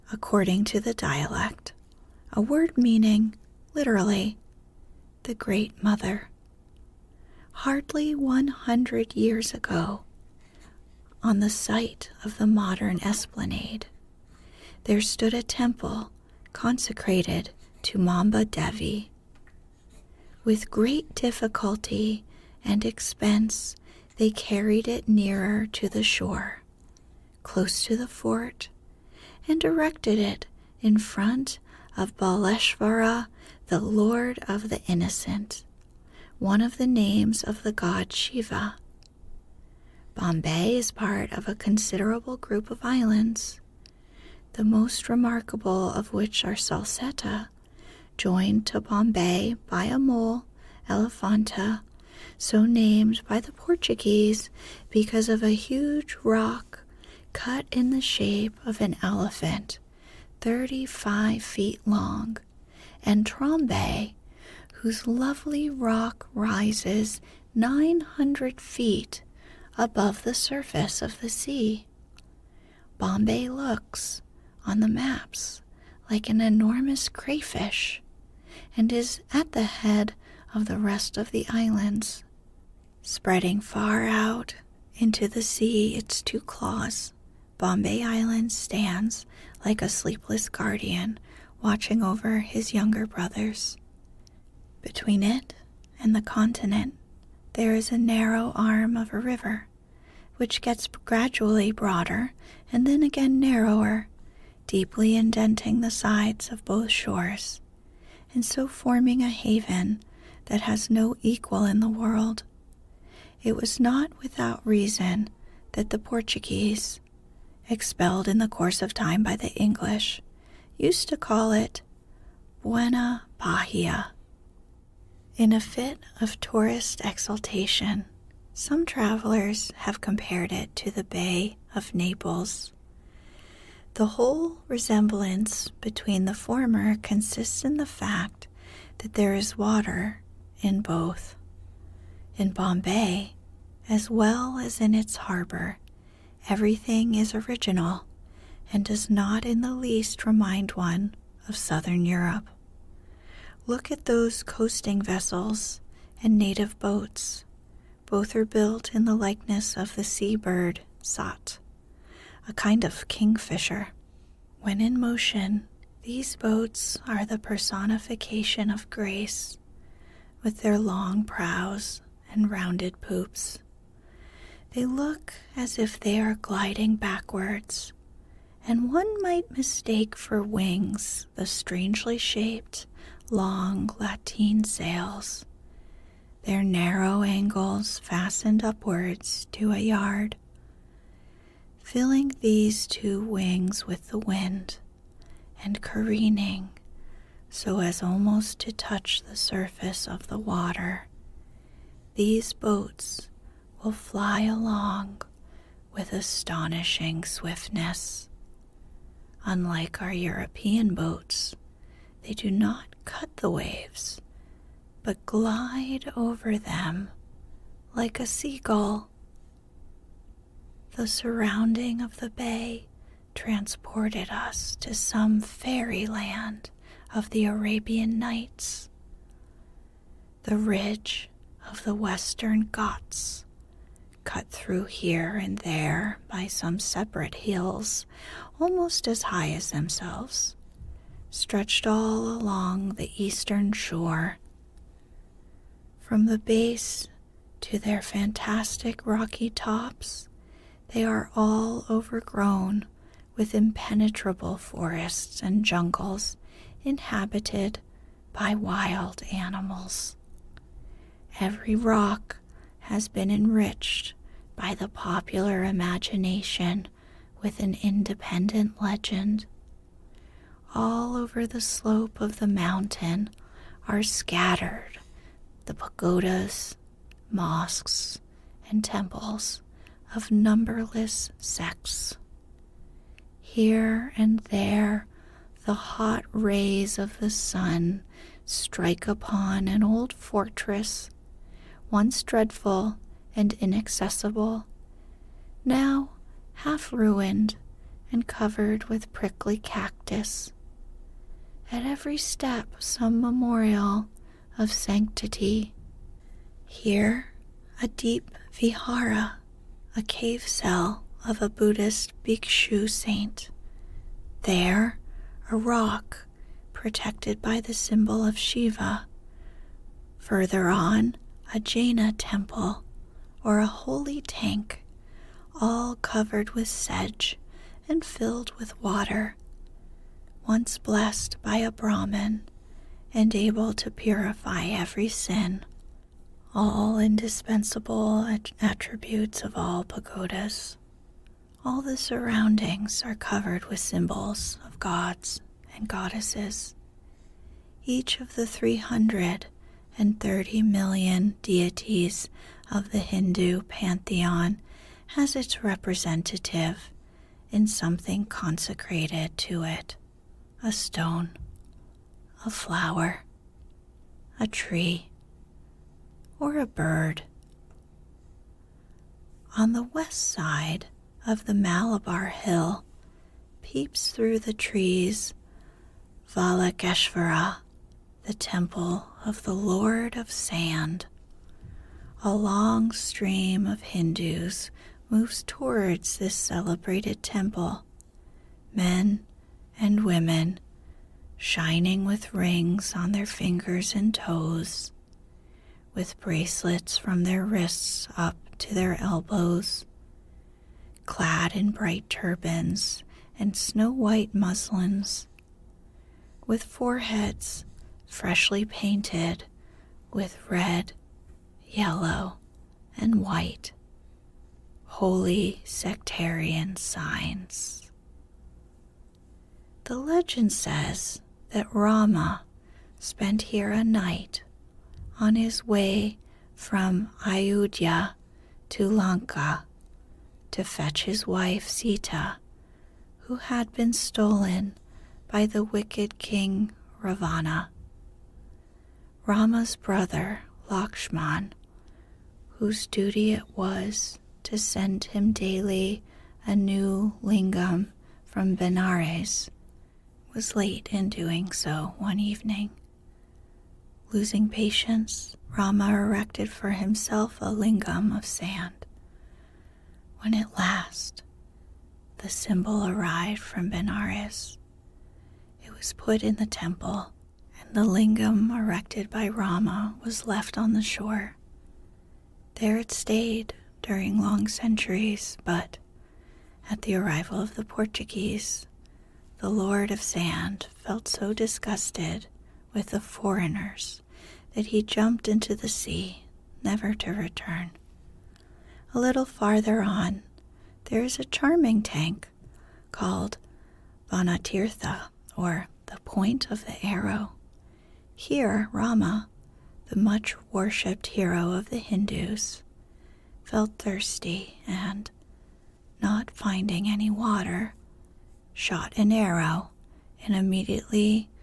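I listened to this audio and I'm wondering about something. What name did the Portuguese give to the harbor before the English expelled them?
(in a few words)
Buena Bahia.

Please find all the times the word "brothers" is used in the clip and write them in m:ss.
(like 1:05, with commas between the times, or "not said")
1:33, 7:19.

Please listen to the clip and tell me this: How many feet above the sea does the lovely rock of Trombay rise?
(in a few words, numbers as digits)
900 feet.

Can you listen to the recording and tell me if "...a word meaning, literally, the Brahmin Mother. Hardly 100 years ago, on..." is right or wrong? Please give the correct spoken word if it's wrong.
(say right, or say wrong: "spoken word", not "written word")
wrong: "Great", not "Brahmin".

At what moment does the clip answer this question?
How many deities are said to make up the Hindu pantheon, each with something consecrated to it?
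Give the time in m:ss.
5:48.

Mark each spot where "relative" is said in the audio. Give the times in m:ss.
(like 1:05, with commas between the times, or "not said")
not said.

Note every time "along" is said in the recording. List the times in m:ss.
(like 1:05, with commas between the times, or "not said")
3:24, 4:02.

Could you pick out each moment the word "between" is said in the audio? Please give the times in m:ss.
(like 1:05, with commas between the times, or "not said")
1:34, 2:15.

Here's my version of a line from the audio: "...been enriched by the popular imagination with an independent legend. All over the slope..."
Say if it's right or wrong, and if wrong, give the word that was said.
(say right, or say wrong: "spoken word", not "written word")
right.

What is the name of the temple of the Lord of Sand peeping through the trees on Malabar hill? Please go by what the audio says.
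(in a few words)
Valakeshvara.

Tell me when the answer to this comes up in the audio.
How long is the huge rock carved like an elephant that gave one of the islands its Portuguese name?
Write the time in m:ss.
1:00.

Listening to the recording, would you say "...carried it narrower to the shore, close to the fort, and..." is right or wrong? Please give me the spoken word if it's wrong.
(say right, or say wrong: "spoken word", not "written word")
wrong: "nearer", not "narrower".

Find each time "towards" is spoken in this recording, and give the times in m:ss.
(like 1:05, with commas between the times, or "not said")
6:25.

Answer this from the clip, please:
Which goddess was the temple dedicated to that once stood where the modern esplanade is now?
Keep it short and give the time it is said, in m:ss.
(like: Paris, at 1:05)
Mamba Devi, at 0:17.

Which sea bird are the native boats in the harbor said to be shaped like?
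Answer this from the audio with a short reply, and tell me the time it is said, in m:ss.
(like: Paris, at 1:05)
Sat, at 2:41.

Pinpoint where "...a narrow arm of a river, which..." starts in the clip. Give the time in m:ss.
1:37.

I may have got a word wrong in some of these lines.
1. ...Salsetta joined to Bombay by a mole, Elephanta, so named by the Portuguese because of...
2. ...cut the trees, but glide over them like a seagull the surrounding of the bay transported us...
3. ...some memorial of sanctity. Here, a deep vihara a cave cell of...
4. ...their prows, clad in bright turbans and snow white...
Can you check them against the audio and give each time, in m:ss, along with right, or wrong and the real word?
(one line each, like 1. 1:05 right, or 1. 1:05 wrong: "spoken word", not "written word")
1. 0:46 right
2. 3:33 wrong: "waves", not "trees"
3. 5:02 right
4. 6:38 wrong: "elbows", not "prows".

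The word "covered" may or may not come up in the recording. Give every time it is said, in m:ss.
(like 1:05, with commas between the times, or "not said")
4:58, 5:26, 5:43.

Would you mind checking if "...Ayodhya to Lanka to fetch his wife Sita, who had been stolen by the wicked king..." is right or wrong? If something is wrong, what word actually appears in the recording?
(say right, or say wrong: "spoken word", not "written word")
right.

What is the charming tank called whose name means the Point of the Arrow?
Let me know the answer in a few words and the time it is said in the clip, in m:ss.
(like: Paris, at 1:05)
Vanatirtha, at 8:14.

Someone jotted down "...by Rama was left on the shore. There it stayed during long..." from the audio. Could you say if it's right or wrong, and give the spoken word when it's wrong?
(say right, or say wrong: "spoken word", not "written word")
right.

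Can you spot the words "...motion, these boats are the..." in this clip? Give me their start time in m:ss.
2:45.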